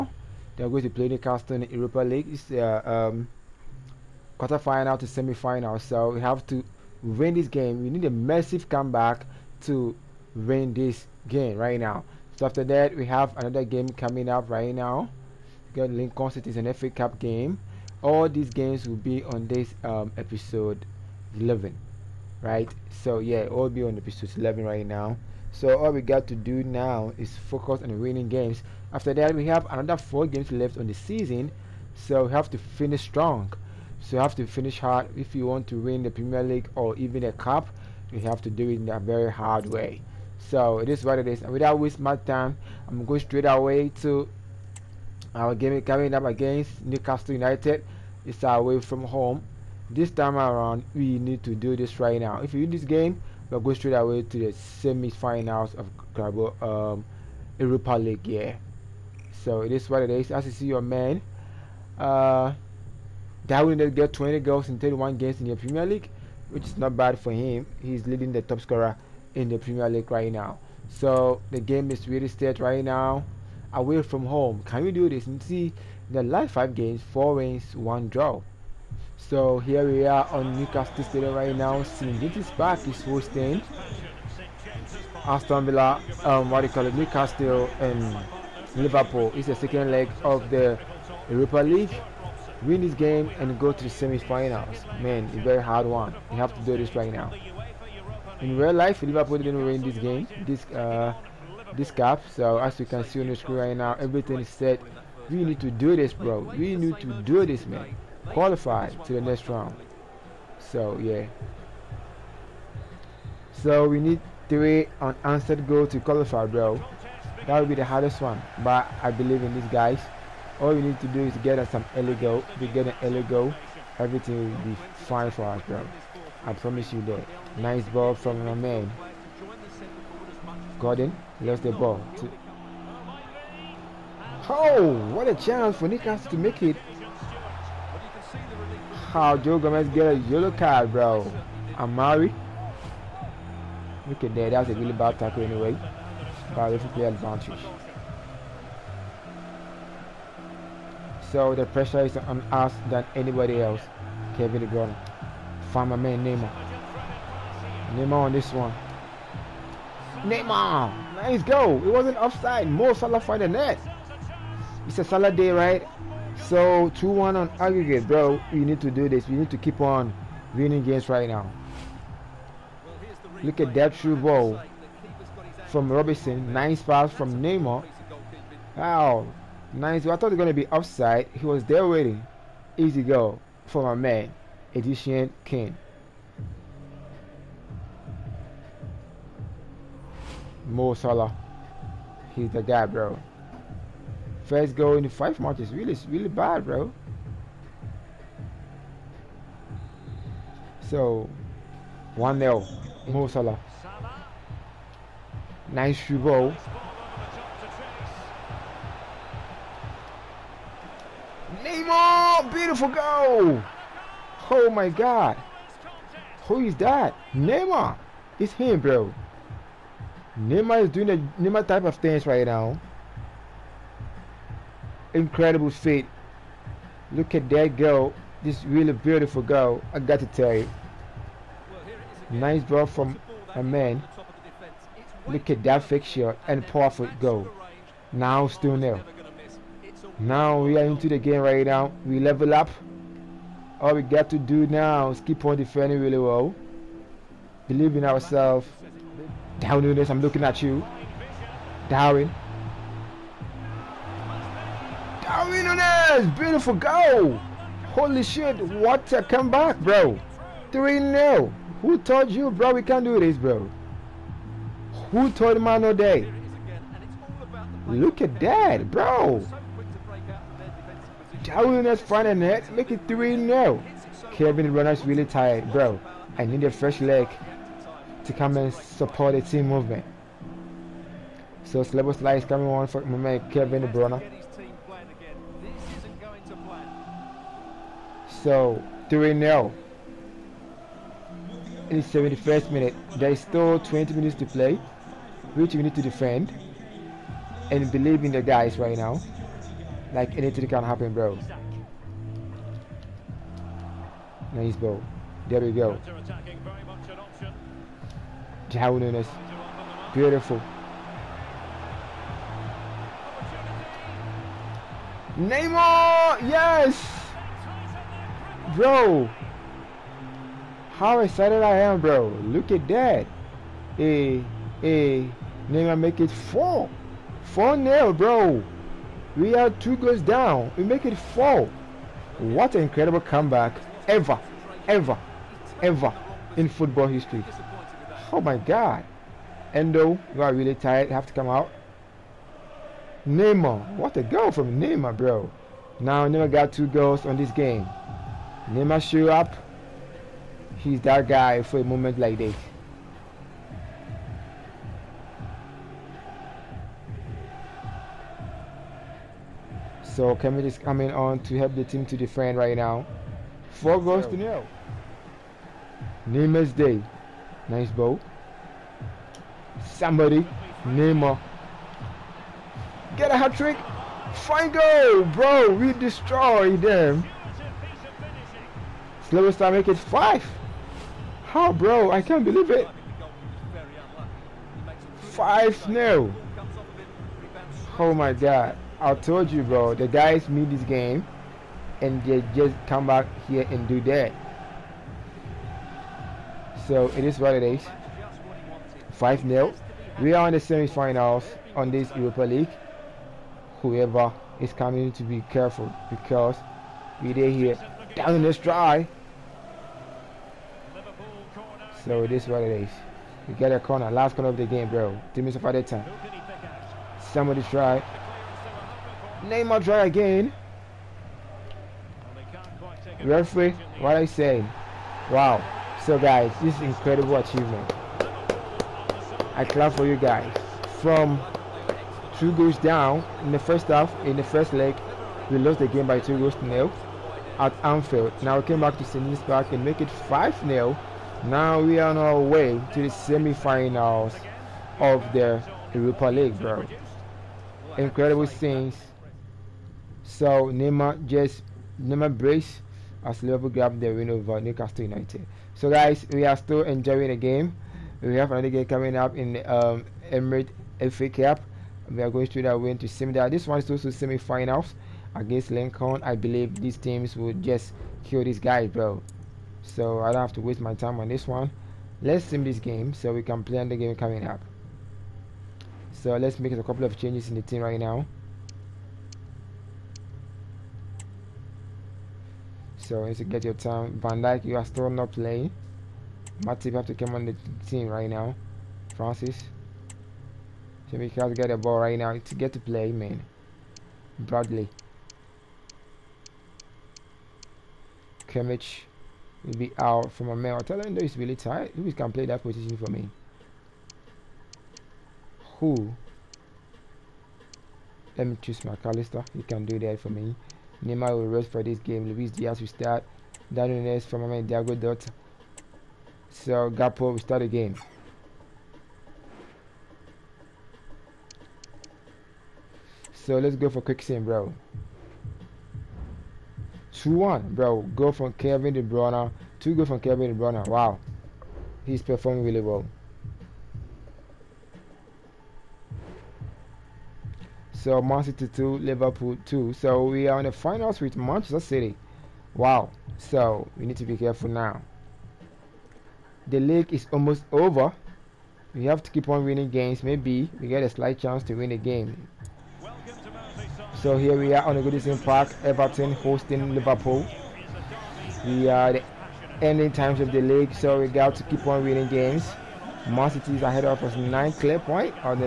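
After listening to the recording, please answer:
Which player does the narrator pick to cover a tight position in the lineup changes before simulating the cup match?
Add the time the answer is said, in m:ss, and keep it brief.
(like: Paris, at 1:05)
Mac Allister, at 8:28.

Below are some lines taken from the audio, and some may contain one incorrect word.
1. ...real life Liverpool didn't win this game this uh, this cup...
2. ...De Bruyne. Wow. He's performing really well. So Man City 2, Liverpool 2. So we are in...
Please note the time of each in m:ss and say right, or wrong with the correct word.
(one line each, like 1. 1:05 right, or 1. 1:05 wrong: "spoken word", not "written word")
1. 1:38 right
2. 8:50 right.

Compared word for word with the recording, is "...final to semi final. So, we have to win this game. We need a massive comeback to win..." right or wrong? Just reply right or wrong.
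right.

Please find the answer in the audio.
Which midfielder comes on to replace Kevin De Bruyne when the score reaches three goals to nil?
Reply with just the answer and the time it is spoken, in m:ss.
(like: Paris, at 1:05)
Szoboszlai, at 4:41.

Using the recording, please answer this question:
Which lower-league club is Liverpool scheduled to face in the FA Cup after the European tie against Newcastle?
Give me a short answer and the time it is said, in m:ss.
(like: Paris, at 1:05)
Lincoln City, at 0:15.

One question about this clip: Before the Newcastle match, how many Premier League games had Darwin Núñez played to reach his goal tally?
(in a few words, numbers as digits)
31.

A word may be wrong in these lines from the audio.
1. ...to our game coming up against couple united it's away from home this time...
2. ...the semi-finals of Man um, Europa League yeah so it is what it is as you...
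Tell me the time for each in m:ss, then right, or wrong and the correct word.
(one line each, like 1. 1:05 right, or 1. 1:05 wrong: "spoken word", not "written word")
1. 0:43 wrong: "newcastle", not "couple"
2. 0:54 wrong: "Carabao", not "Man".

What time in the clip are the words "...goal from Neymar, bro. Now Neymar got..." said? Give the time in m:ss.
5:44.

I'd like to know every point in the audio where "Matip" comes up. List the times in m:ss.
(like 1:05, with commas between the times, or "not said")
8:06.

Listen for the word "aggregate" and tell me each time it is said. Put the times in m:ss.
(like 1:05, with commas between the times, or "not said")
2:47.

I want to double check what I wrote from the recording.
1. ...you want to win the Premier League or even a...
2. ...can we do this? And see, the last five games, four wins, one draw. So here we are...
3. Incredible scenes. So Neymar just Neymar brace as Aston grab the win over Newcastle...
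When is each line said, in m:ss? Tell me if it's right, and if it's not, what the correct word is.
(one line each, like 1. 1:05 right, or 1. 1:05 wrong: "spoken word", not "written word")
1. 0:35 right
2. 1:14 right
3. 7:27 wrong: "Liverpool", not "Aston".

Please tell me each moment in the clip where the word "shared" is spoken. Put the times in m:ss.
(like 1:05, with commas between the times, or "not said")
not said.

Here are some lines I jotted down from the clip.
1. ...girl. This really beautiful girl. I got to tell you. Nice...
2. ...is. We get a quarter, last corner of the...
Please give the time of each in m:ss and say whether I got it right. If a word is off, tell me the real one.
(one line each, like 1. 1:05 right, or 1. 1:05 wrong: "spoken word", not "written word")
1. 3:47 right
2. 6:52 wrong: "corner", not "quarter".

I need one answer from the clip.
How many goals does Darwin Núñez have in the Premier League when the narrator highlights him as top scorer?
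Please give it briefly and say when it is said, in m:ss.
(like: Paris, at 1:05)
20, at 1:04.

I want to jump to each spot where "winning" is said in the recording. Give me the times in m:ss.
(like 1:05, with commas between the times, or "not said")
0:27, 2:50, 9:09, 9:22.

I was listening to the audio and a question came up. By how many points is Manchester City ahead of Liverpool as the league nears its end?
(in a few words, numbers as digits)
9.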